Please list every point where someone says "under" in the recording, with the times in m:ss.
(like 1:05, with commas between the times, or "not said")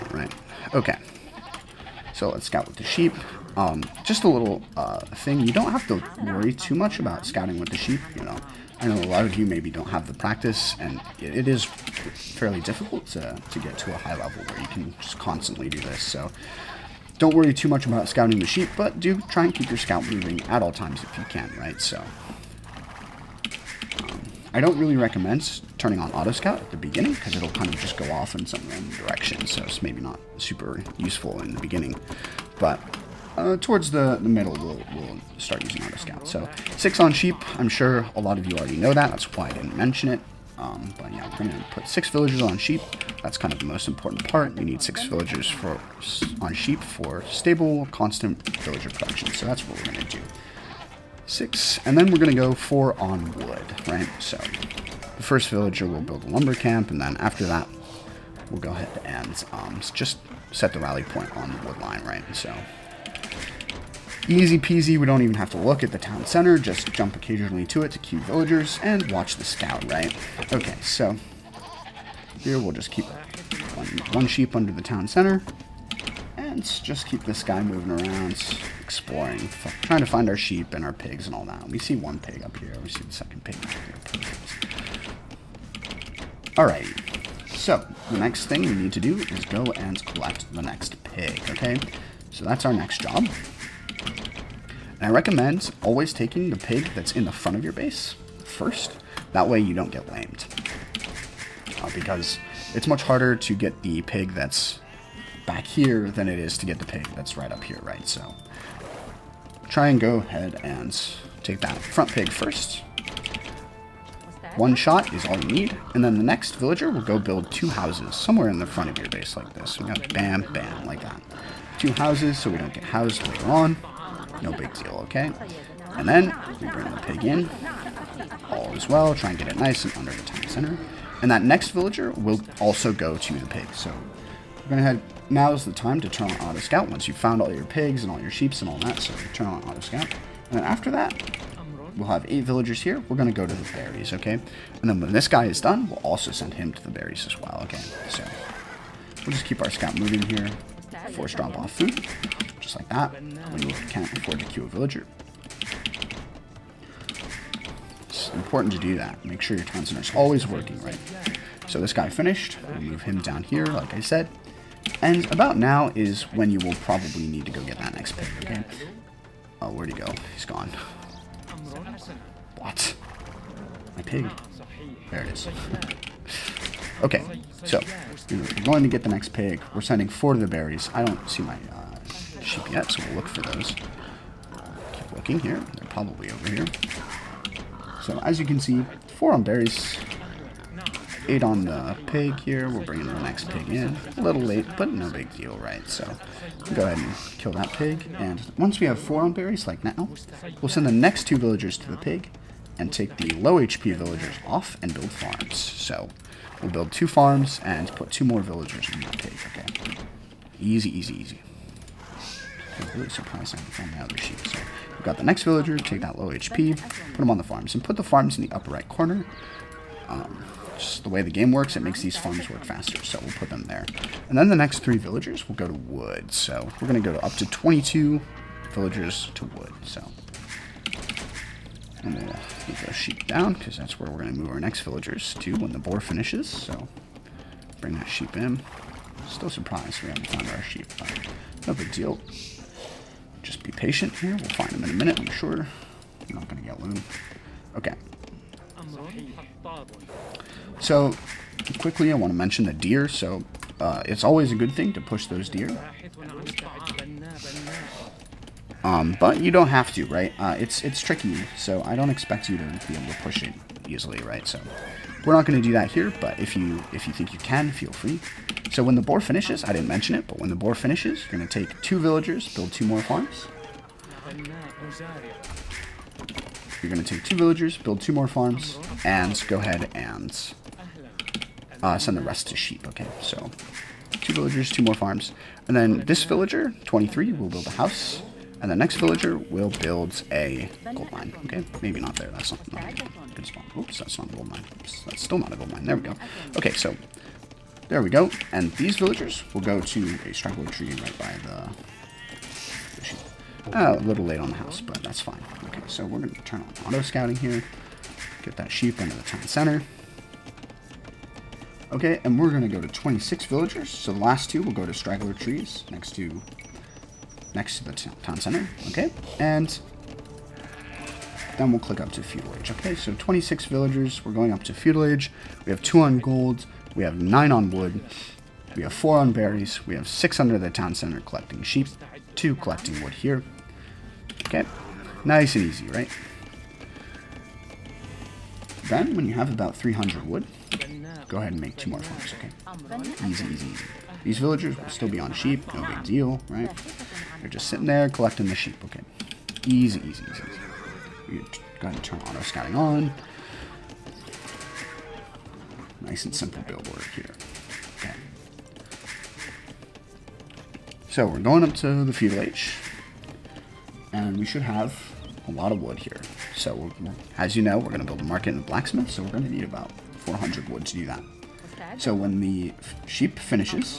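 1:14, 2:09, 5:30.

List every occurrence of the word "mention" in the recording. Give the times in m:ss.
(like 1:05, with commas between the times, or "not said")
0:39, 4:12, 4:29.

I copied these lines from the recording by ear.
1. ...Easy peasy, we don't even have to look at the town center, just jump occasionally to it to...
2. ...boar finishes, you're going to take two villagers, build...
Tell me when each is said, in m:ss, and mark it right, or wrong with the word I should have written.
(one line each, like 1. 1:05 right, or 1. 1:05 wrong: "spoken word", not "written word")
1. 1:04 right
2. 4:30 right.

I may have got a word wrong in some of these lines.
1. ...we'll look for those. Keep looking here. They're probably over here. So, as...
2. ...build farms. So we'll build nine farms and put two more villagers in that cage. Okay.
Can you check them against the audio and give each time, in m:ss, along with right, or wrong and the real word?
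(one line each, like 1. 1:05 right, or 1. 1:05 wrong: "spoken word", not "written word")
1. 3:03 right
2. 3:24 wrong: "two", not "nine".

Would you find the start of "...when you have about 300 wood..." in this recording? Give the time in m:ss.
5:39.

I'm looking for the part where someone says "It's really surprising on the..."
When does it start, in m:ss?
3:32.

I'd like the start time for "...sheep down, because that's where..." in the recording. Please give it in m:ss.
3:52.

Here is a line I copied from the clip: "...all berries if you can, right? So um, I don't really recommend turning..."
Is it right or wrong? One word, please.
wrong.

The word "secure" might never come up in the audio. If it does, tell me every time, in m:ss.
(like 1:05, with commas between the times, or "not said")
not said.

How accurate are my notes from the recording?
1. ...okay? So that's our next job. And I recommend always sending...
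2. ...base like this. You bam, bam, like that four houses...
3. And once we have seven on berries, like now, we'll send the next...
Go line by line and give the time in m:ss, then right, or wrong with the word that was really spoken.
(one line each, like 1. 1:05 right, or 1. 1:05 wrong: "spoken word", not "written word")
1. 1:31 wrong: "taking", not "sending"
2. 1:59 wrong: "two", not "four"
3. 3:18 wrong: "four", not "seven".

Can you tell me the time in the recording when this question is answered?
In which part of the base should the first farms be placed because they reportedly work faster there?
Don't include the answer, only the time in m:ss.
3:38.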